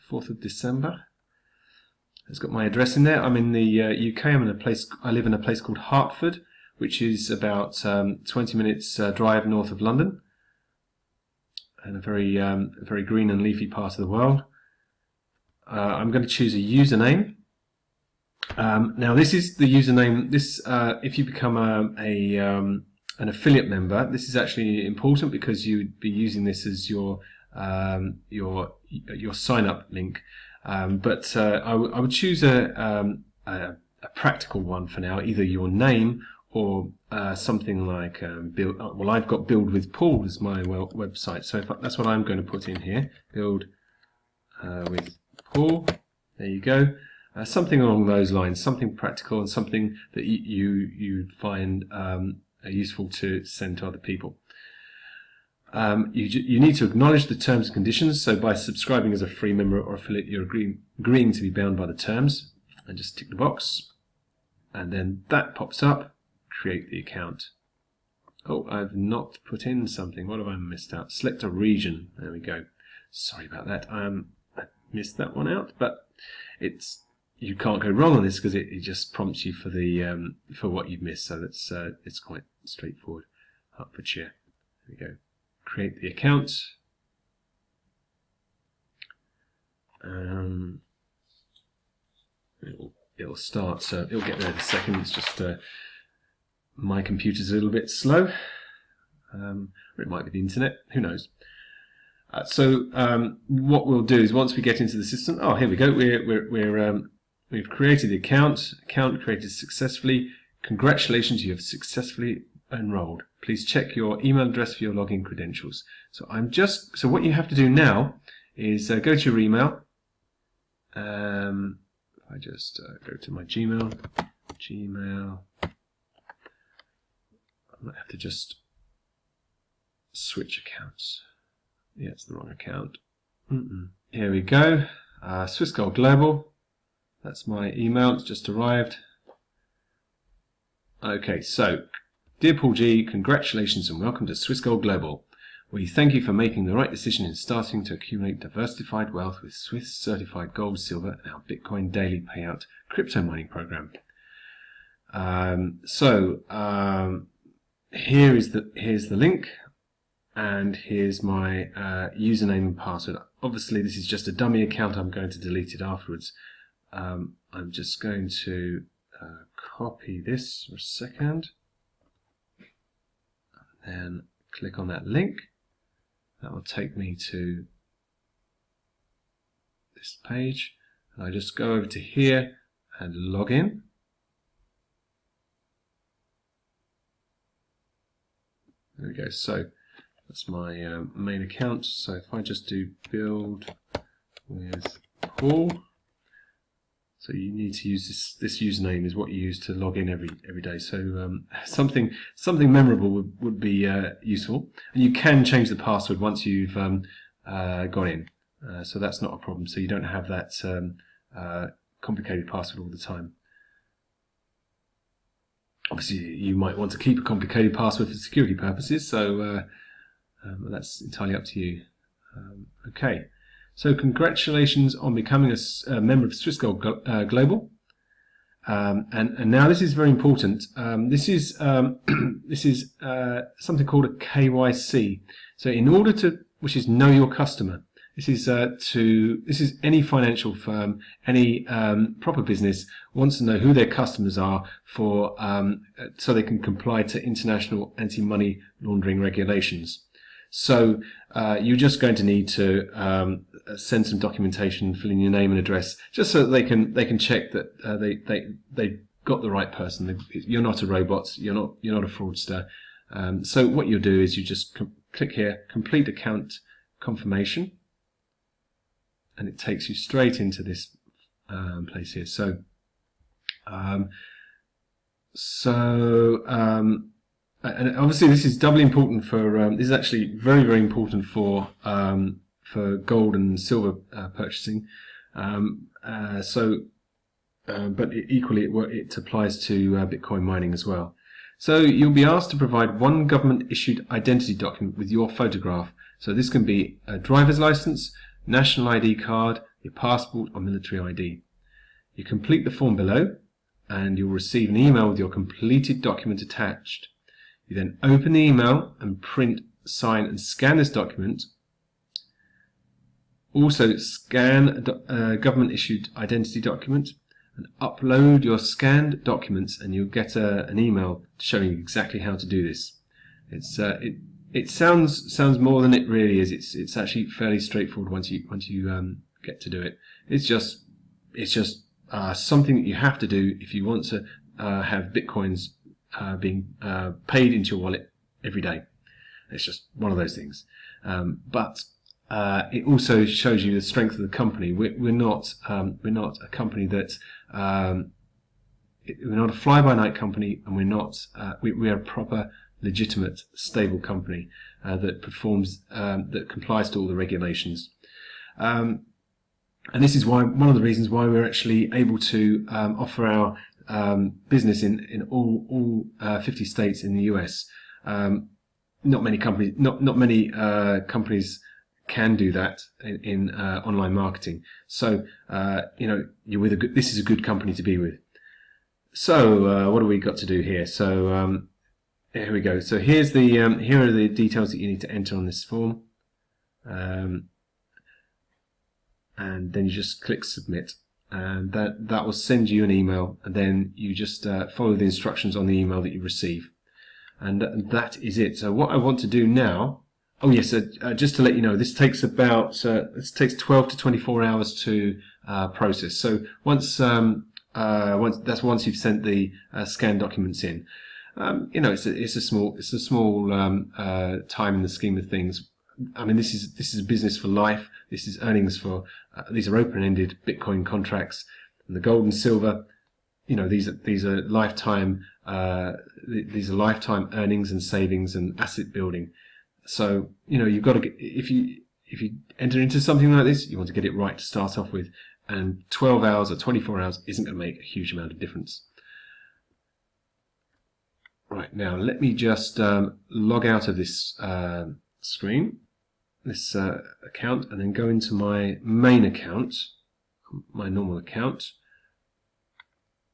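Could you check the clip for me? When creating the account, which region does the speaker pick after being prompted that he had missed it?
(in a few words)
Hertfordshire.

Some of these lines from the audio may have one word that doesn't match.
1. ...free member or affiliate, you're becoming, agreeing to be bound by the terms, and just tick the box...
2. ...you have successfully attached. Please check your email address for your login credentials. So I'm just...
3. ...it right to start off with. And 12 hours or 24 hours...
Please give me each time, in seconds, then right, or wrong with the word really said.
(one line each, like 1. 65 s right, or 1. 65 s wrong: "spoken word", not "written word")
1. 59 s wrong: "agreeing", not "becoming"
2. 111 s wrong: "enrolled", not "attached"
3. 434 s right.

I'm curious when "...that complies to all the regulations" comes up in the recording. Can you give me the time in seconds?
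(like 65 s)
356 s.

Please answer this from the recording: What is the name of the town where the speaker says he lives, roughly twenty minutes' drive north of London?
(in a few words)
Hertford.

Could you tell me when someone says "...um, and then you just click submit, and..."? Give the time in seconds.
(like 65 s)
386 s.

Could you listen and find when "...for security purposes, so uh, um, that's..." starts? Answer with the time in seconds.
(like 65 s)
218 s.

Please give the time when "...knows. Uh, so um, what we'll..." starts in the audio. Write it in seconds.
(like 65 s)
101 s.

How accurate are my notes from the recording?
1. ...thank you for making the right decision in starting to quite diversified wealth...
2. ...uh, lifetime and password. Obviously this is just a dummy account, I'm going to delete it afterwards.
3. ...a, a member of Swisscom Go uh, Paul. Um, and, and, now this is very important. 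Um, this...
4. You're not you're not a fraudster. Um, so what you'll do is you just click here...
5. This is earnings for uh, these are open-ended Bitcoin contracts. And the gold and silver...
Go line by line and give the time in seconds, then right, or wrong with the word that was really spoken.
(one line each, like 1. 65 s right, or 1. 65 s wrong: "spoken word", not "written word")
1. 145 s wrong: "accumulate", not "quite"
2. 161 s wrong: "username", not "lifetime"
3. 225 s wrong: "Global", not "Paul"
4. 261 s right
5. 418 s right.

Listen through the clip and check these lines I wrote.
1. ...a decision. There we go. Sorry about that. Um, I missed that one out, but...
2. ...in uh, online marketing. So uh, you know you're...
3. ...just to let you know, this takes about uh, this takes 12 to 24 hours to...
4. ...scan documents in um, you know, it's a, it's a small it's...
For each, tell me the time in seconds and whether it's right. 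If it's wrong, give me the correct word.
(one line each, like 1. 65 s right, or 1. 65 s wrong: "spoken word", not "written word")
1. 71 s wrong: "region", not "decision"
2. 373 s right
3. 401 s right
4. 409 s right.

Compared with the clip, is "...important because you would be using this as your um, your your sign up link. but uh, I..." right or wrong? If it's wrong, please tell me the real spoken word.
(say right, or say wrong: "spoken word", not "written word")
right.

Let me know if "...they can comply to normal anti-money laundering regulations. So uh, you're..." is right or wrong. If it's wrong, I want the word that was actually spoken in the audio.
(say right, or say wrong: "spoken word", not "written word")
wrong: "international", not "normal".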